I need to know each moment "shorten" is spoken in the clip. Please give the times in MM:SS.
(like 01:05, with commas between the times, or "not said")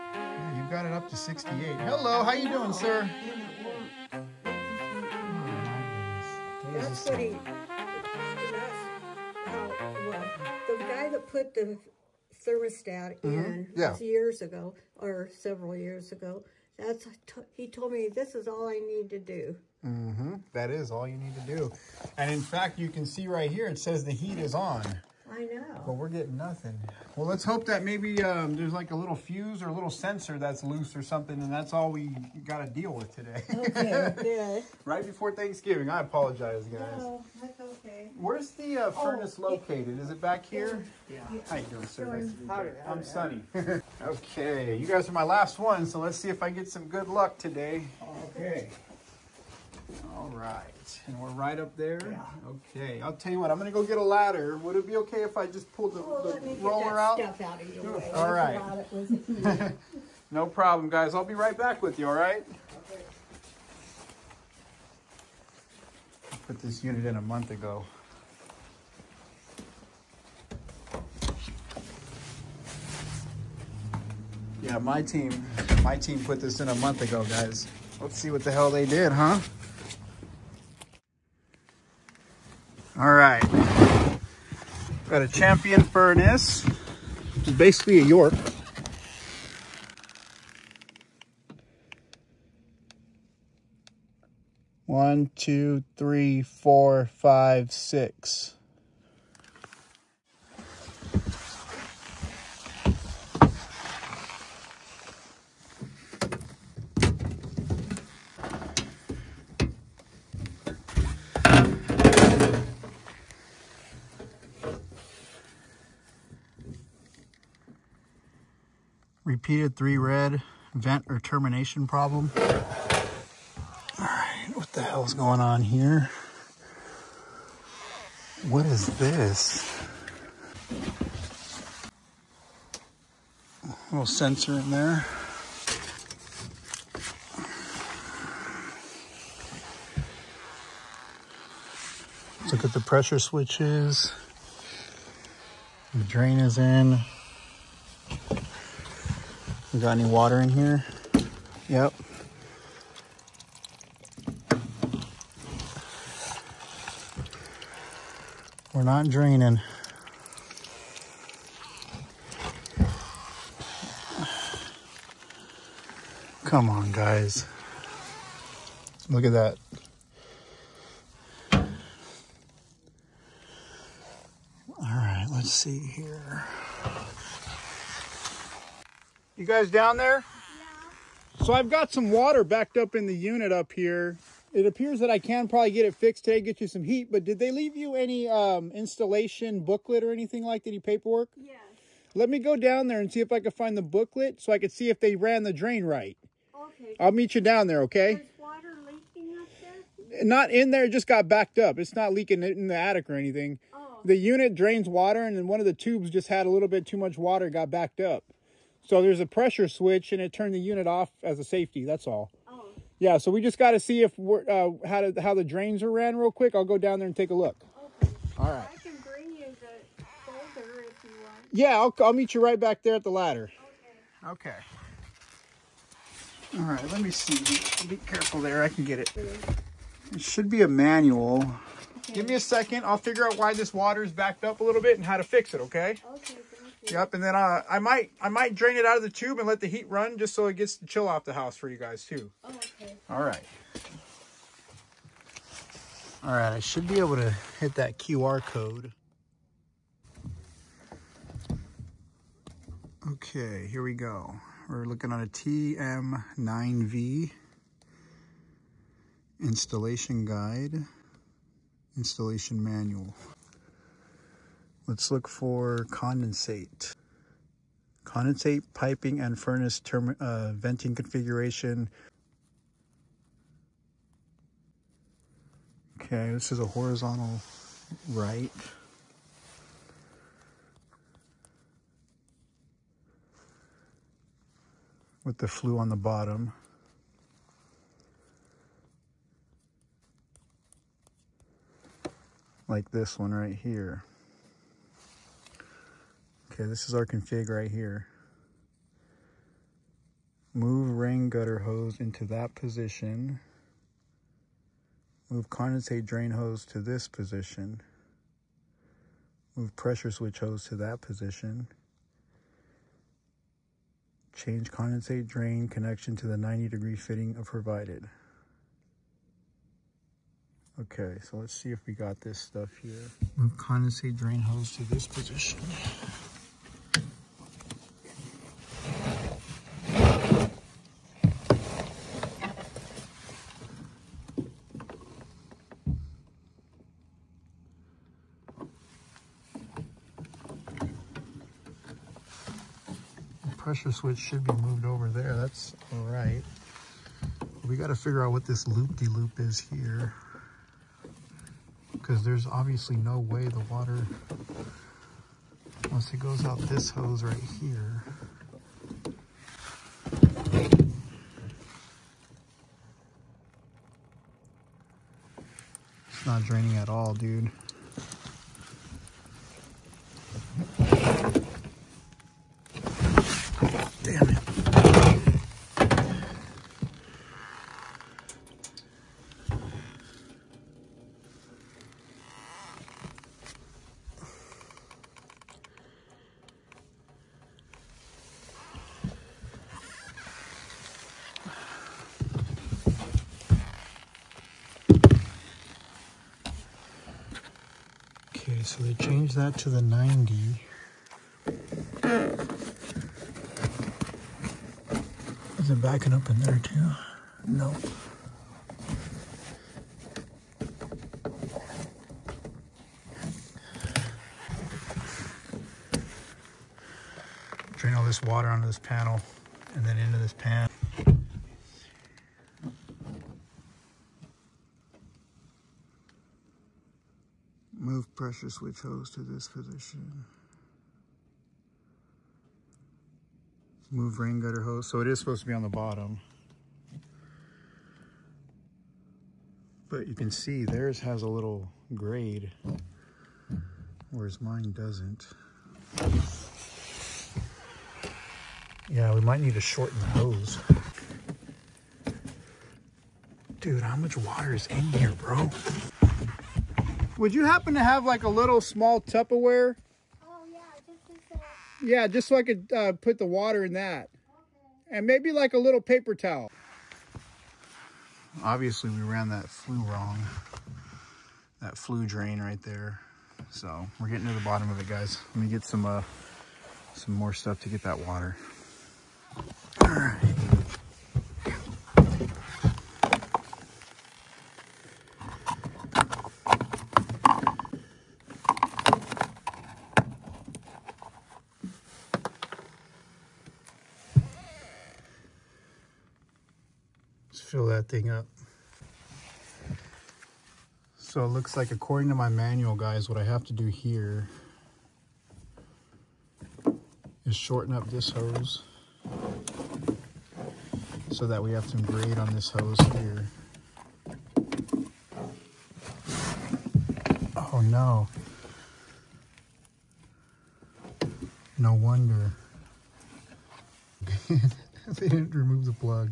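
07:29, 08:27.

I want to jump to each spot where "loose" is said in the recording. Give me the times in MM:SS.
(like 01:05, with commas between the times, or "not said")
00:30.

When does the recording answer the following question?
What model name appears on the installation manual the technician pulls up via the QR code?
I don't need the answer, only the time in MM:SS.
04:15.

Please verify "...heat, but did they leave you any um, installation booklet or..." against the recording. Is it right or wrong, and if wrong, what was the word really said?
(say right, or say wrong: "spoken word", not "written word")
right.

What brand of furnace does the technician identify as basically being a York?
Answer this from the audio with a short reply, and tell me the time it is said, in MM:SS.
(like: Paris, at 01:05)
Champion, at 01:25.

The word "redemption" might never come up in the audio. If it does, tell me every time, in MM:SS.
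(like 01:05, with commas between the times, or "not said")
not said.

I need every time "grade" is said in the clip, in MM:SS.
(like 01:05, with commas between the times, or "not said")
07:21, 08:31.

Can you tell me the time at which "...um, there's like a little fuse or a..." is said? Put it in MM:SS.
00:28.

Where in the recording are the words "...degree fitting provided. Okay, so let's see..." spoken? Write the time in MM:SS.
05:16.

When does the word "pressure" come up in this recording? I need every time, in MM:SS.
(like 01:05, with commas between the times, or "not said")
02:22, 03:29, 05:09, 05:43, 07:08.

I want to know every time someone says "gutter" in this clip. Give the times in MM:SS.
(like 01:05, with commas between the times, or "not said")
05:01, 07:14.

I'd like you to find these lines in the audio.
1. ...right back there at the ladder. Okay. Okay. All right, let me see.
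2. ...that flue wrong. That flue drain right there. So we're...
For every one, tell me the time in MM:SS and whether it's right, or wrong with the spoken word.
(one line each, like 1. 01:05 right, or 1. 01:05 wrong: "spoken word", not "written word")
1. 03:42 right
2. 07:49 right.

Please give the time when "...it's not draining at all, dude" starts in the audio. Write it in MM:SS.
06:06.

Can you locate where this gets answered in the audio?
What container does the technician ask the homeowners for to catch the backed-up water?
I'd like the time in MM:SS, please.
07:38.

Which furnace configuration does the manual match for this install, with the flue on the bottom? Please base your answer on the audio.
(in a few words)
horizontal right.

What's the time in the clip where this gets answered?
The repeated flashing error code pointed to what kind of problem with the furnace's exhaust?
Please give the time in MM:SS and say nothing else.
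02:00.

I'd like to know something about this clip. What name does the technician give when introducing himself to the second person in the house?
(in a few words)
Sonny.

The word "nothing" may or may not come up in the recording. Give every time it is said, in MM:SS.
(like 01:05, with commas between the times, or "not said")
00:26.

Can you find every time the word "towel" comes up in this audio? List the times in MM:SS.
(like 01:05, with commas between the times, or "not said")
07:46.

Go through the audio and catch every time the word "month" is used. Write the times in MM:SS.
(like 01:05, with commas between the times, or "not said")
01:07, 01:16.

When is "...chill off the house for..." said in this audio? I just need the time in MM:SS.
04:00.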